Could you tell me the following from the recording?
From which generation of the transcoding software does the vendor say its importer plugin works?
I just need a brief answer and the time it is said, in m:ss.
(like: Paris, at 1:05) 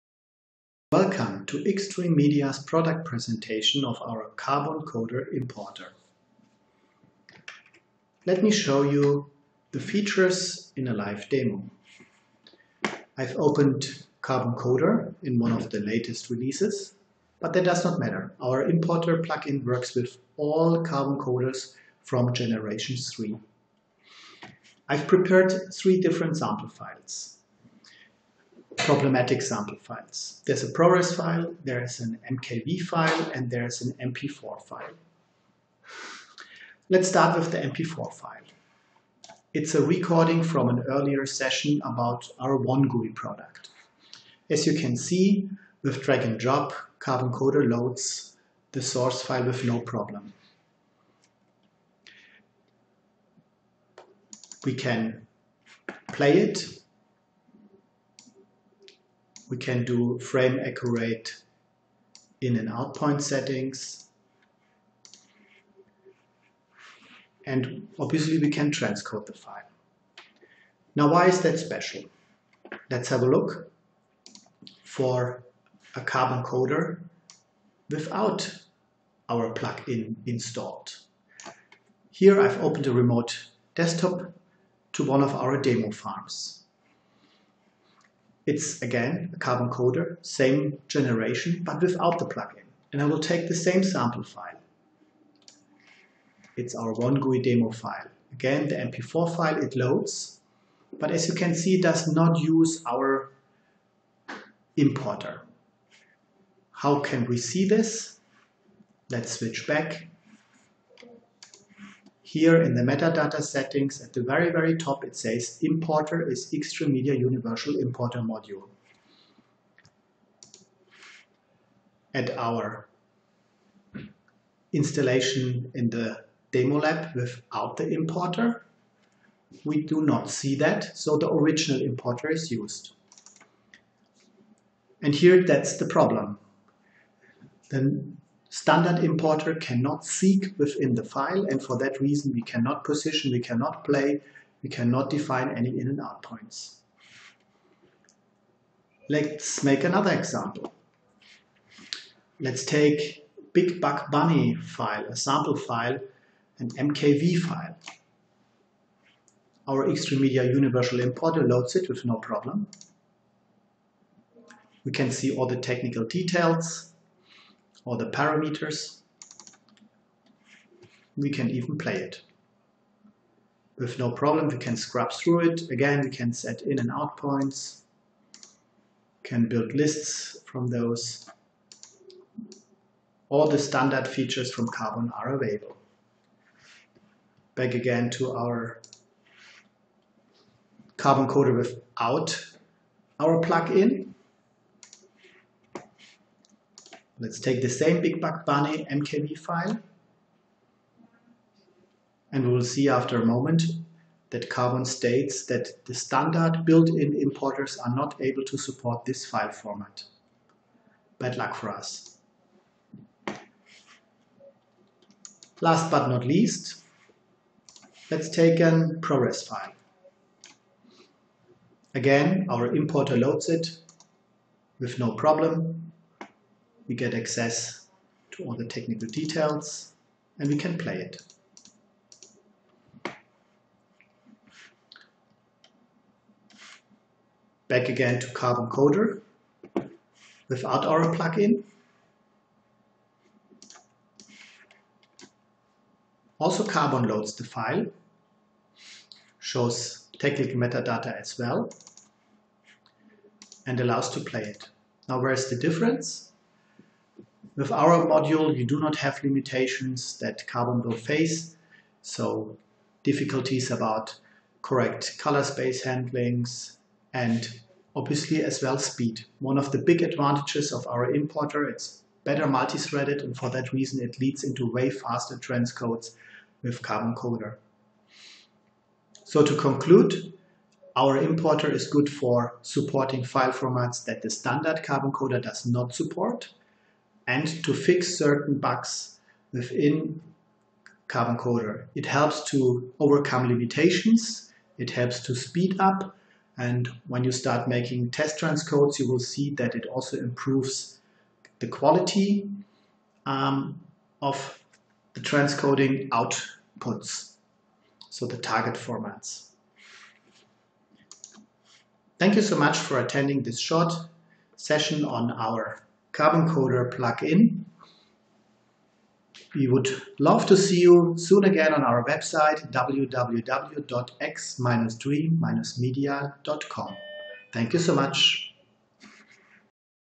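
Generation 3, at 0:22.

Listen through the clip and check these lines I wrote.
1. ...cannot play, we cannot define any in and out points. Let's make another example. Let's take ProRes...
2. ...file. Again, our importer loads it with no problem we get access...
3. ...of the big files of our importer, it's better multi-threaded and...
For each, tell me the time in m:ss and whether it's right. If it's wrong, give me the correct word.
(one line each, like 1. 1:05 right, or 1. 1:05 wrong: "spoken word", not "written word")
1. 2:23 wrong: "Big", not "ProRes"
2. 3:39 right
3. 4:29 wrong: "advantages", not "files".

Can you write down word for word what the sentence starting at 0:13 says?
I've opened Carbon Coder in one of the latest releases, but that does not matter.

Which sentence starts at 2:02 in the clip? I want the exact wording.
At our installation in the demo lab without the importer, we do not see that, so the original importer is used.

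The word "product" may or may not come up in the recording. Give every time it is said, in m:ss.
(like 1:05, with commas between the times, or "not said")
0:02, 0:43.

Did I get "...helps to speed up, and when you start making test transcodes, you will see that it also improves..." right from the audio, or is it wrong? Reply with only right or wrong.
right.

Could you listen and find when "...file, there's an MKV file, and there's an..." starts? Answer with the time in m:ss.
0:31.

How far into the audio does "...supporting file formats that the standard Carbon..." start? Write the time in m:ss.
4:42.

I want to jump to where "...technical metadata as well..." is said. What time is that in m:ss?
4:10.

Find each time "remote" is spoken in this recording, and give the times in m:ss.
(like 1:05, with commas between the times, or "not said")
1:22.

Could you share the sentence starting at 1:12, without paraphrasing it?
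Let's have a look for a carbon coder without our plugin installed.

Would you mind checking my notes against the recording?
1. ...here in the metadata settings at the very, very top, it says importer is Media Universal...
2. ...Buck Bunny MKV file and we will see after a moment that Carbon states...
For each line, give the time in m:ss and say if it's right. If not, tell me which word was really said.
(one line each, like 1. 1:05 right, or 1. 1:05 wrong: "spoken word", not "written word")
1. 1:52 right
2. 3:18 right.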